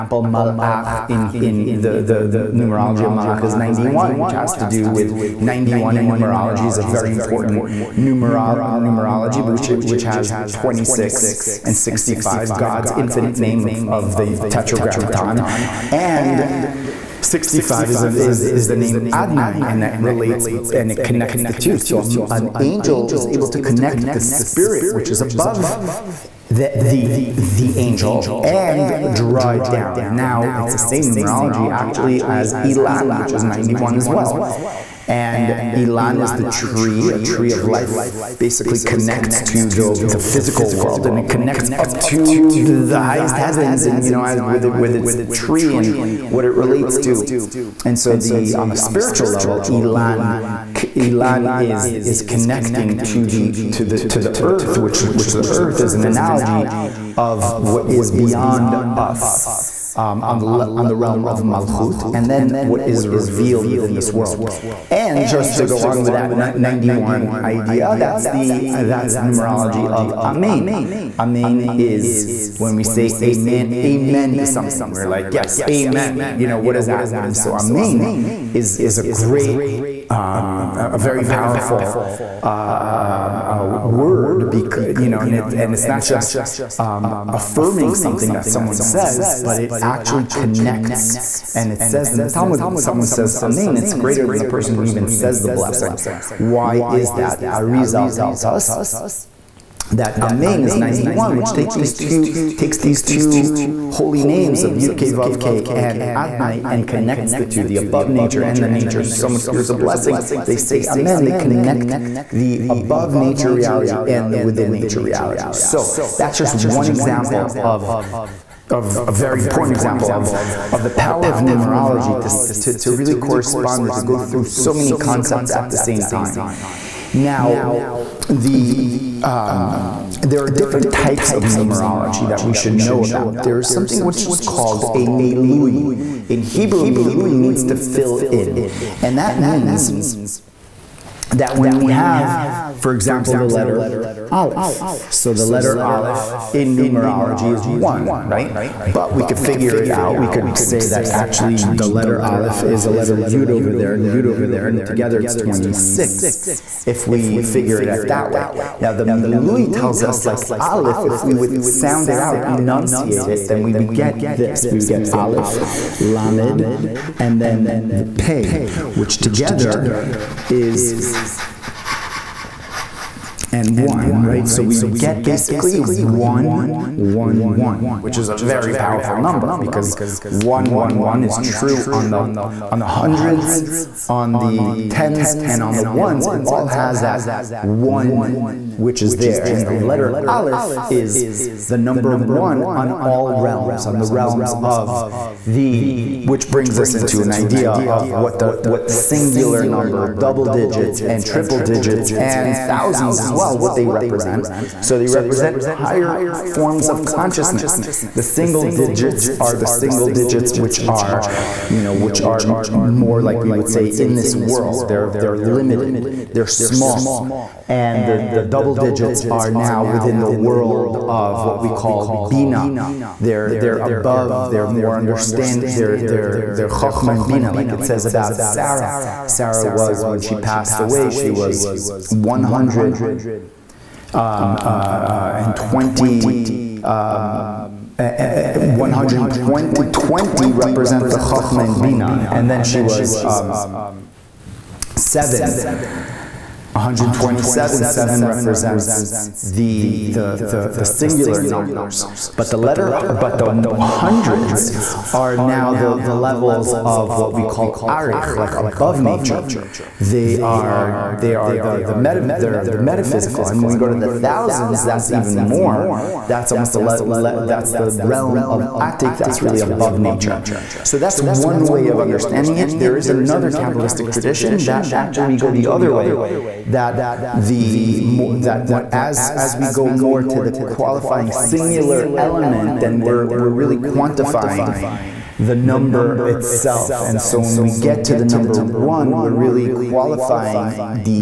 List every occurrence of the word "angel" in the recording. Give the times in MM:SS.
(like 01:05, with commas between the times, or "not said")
00:22, 00:27.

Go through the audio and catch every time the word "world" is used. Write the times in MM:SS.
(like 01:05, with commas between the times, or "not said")
00:40, 01:04, 03:34, 03:40.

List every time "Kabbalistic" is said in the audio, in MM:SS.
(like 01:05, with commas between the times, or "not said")
04:33.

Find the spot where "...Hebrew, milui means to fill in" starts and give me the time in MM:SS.
02:16.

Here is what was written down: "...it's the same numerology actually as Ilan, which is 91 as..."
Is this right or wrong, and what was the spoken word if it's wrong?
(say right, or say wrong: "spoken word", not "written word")
right.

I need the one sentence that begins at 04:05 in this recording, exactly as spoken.
127, 7 represents the, the, the, the, singular numbers.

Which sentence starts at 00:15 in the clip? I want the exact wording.
And 65 is, an, is, is the name Adnai, and that relates and it connects the two.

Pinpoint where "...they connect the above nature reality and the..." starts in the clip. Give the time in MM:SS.
01:51.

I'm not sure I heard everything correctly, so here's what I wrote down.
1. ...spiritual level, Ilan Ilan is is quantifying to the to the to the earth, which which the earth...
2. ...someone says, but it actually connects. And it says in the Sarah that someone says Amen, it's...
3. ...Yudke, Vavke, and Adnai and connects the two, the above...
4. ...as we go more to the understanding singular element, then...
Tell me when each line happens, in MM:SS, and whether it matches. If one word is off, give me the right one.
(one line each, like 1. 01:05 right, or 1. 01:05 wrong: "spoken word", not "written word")
1. 00:48 wrong: "connecting", not "quantifying"
2. 01:28 wrong: "Talmud", not "Sarah"
3. 01:44 right
4. 04:39 wrong: "qualifying", not "understanding".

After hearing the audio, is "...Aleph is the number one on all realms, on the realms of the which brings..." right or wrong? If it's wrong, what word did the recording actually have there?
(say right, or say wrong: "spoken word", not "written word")
right.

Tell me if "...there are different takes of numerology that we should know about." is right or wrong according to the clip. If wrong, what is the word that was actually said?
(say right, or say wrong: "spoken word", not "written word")
wrong: "types", not "takes".